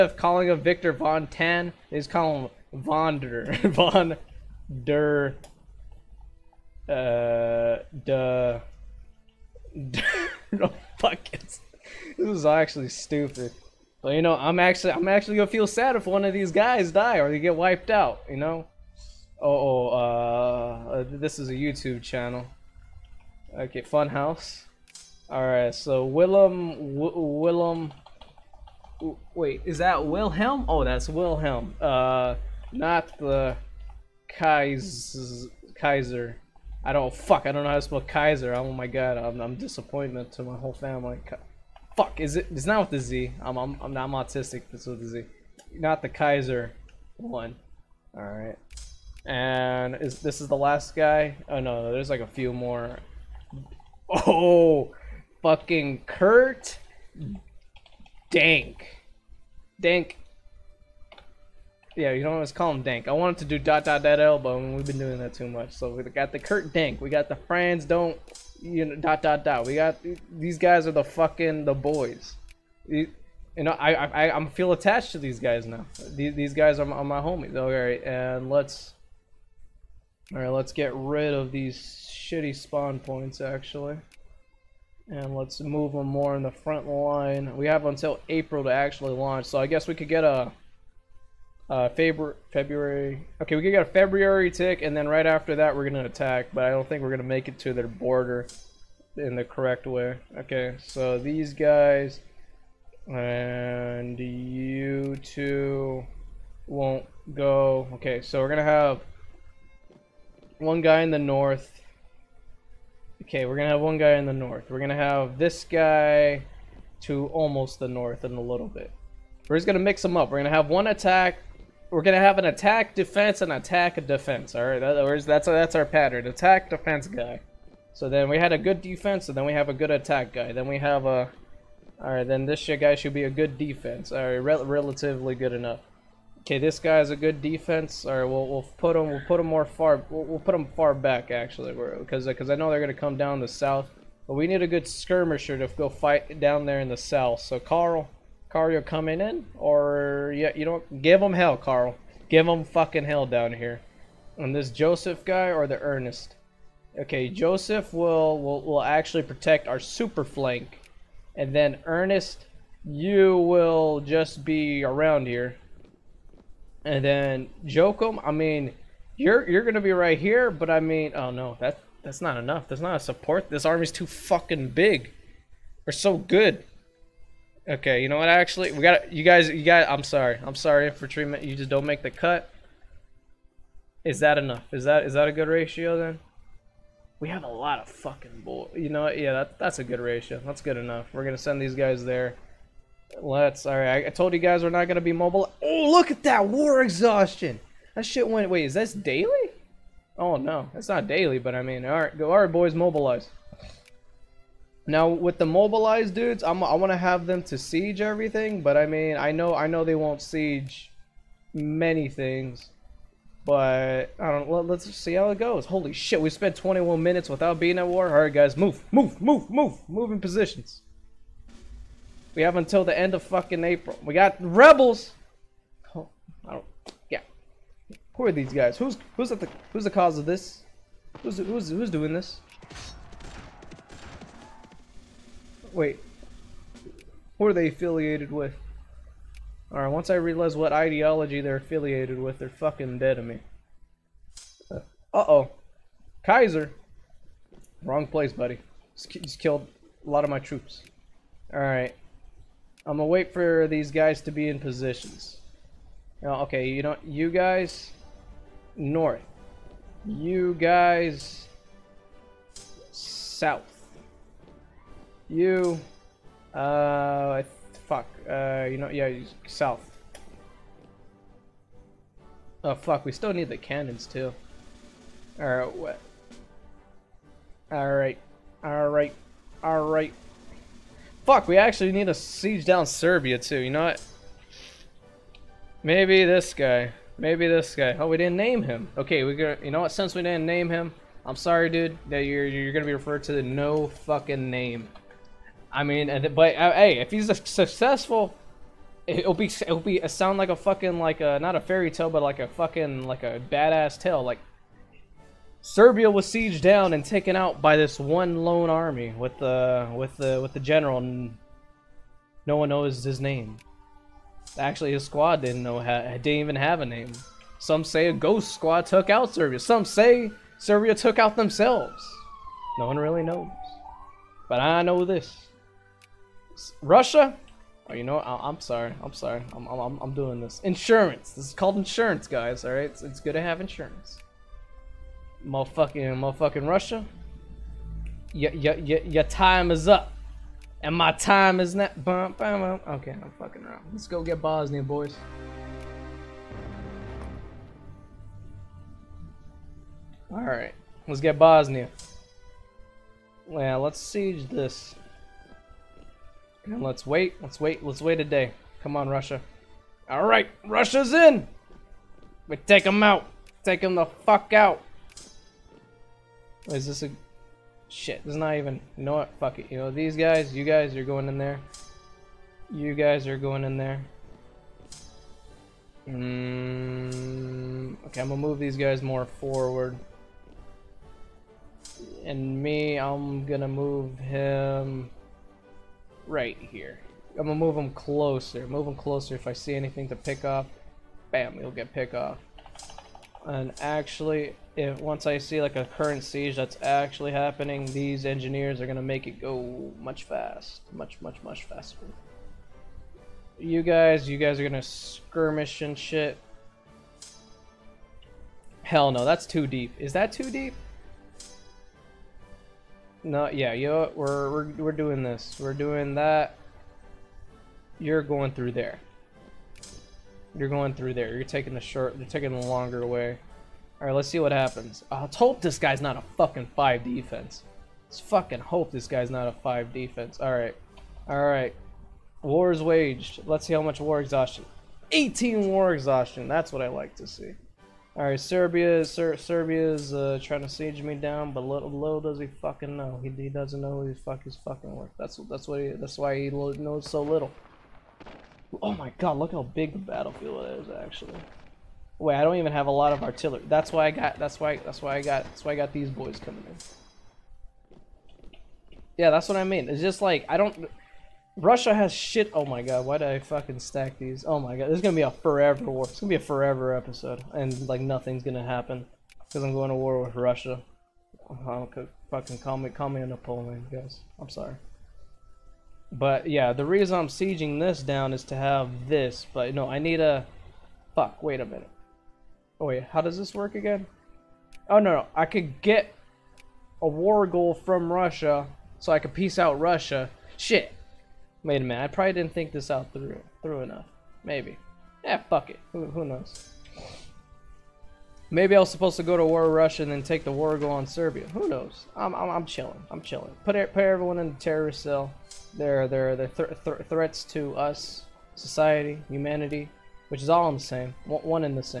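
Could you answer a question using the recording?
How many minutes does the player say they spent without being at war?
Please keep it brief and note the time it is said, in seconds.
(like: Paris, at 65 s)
21, at 216 s.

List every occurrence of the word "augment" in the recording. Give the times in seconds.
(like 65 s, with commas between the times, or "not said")
not said.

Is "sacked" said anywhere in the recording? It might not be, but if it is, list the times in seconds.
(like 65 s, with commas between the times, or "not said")
not said.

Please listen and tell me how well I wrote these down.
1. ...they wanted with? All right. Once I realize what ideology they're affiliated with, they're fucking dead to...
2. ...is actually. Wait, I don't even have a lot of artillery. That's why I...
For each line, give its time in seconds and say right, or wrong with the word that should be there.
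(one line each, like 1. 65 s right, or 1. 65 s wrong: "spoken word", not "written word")
1. 237 s wrong: "affiliated", not "wanted"
2. 450 s right.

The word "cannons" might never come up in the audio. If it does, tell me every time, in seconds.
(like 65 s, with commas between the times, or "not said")
273 s.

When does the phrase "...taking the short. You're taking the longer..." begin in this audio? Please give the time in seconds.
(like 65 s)
421 s.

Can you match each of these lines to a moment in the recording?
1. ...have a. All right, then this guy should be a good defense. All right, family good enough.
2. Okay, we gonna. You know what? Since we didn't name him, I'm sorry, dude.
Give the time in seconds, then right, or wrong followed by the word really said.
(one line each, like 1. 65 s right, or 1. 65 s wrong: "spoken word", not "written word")
1. 130 s wrong: "relatively", not "family"
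2. 288 s right.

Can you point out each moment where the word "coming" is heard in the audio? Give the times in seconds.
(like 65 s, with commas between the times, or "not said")
148 s, 456 s.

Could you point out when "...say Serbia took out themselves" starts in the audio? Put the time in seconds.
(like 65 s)
319 s.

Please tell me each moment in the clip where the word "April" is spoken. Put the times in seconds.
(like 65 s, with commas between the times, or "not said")
88 s, 223 s.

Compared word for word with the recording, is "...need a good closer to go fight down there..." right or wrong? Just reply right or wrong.
wrong.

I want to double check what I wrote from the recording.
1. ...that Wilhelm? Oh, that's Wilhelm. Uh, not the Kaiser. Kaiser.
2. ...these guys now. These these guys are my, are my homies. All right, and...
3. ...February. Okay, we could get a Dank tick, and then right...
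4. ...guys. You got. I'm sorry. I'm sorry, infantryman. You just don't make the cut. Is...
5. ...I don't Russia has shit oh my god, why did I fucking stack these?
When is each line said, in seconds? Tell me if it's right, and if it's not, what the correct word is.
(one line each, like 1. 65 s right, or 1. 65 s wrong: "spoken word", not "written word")
1. 29 s right
2. 75 s right
3. 92 s wrong: "February", not "Dank"
4. 179 s right
5. 460 s right.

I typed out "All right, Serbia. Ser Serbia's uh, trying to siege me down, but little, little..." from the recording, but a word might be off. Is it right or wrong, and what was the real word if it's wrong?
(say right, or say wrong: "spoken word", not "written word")
right.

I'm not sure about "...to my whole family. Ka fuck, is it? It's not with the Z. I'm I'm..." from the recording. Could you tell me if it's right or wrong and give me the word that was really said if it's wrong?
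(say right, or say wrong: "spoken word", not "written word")
right.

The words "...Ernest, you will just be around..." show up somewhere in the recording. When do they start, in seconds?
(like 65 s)
161 s.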